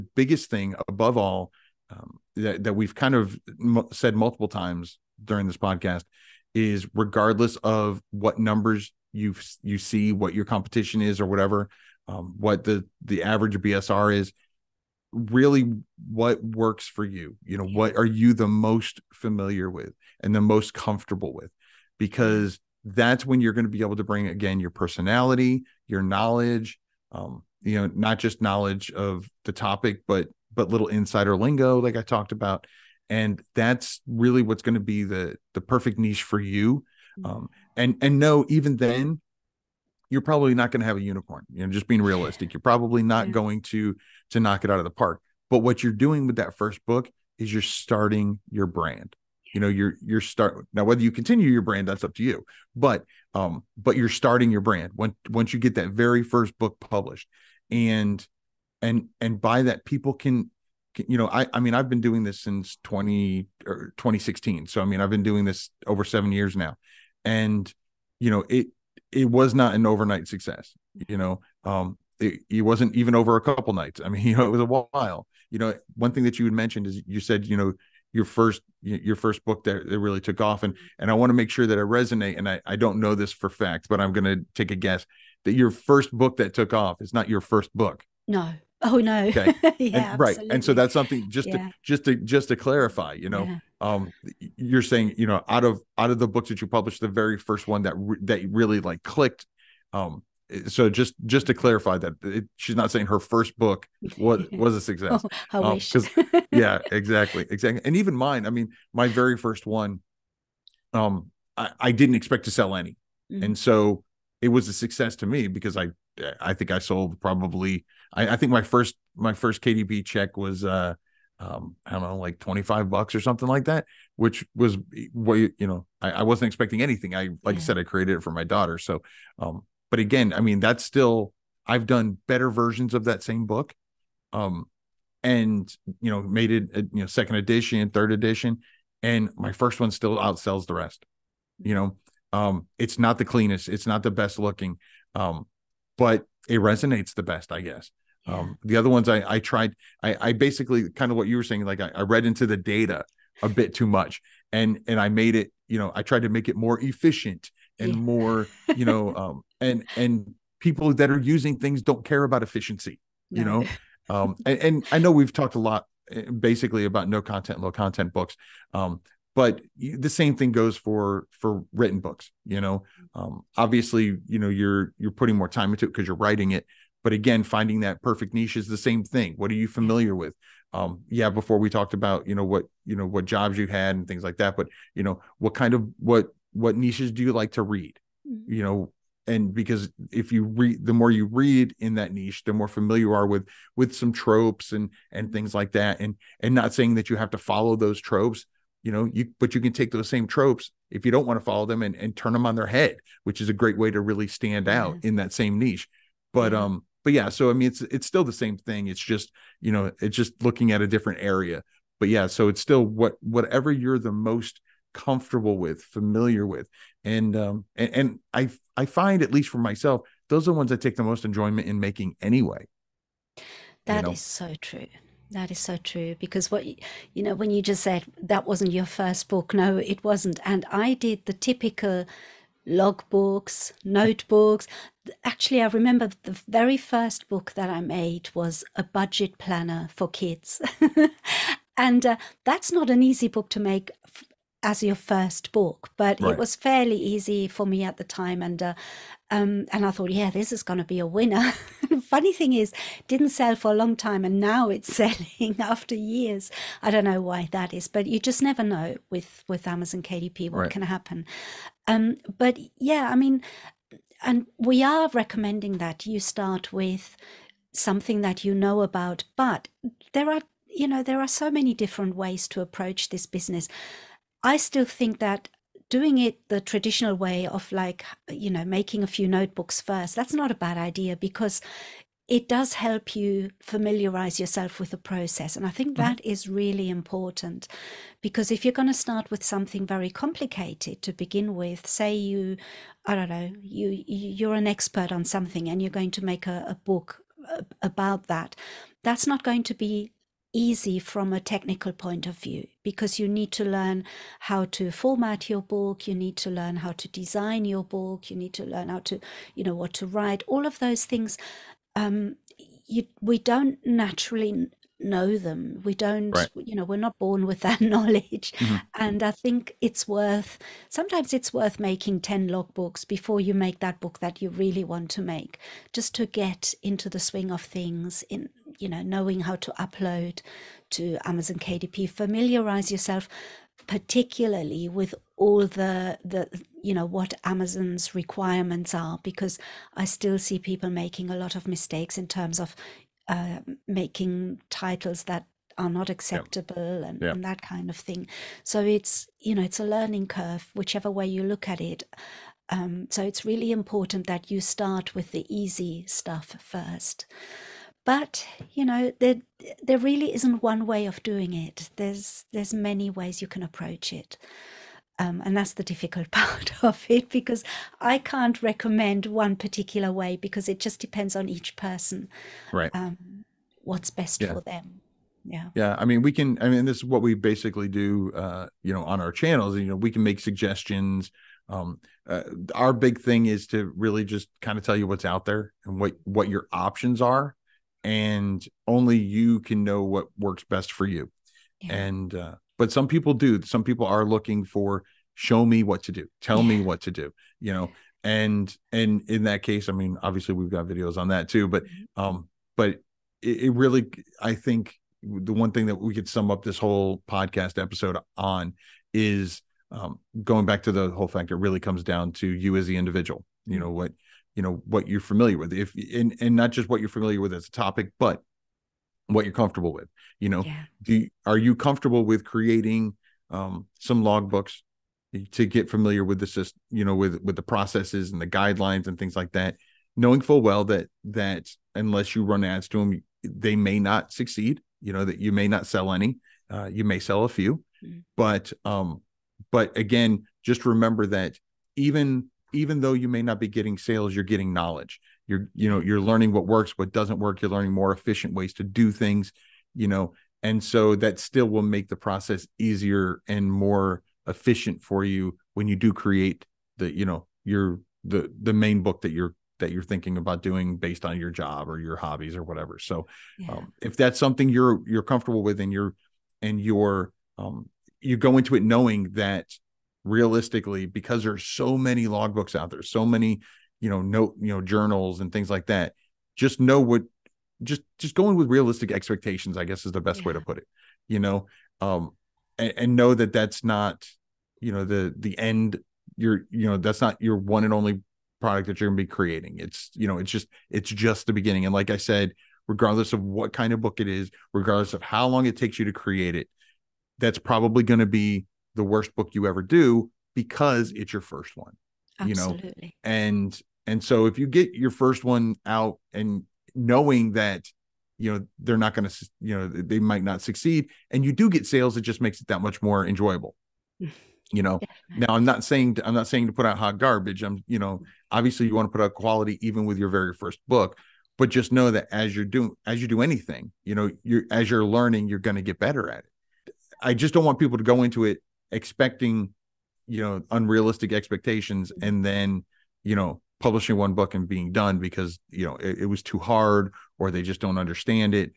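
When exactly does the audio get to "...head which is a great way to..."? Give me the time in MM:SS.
03:22.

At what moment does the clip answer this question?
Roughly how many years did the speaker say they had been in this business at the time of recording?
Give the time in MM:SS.
01:05.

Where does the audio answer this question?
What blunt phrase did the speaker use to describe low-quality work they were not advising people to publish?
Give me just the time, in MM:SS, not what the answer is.
08:36.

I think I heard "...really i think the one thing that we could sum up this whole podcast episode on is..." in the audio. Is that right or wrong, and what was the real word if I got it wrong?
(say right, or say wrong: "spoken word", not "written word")
right.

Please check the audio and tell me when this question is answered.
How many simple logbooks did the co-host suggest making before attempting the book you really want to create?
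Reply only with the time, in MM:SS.
05:22.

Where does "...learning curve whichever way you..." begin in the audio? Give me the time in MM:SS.
05:49.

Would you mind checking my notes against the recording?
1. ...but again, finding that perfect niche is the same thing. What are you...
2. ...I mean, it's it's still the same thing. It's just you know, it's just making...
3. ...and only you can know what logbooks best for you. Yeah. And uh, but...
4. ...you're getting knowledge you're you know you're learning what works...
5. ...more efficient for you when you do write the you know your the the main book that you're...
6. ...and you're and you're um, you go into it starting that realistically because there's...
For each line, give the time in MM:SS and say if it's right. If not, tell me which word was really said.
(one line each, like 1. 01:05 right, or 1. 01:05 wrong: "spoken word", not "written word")
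1. 02:57 right
2. 03:27 wrong: "looking", not "making"
3. 06:28 wrong: "works", not "logbooks"
4. 07:24 right
5. 07:33 wrong: "create", not "write"
6. 07:45 wrong: "knowing", not "starting".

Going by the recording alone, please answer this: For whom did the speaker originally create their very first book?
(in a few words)
daughter.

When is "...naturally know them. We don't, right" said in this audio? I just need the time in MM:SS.
05:13.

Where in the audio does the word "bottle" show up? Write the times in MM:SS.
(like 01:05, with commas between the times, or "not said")
not said.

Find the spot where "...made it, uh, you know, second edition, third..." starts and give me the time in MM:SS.
02:16.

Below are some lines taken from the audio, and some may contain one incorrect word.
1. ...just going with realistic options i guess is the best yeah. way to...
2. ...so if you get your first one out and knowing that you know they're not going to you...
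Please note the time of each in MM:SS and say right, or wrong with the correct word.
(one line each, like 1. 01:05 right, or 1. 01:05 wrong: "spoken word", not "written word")
1. 07:58 wrong: "expectations", not "options"
2. 08:24 right.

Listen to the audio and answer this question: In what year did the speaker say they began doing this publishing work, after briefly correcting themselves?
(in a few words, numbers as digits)
2016.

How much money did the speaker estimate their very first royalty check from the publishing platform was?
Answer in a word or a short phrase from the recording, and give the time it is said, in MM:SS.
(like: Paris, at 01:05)
$25, at 02:02.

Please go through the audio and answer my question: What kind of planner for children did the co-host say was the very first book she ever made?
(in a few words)
budget planner.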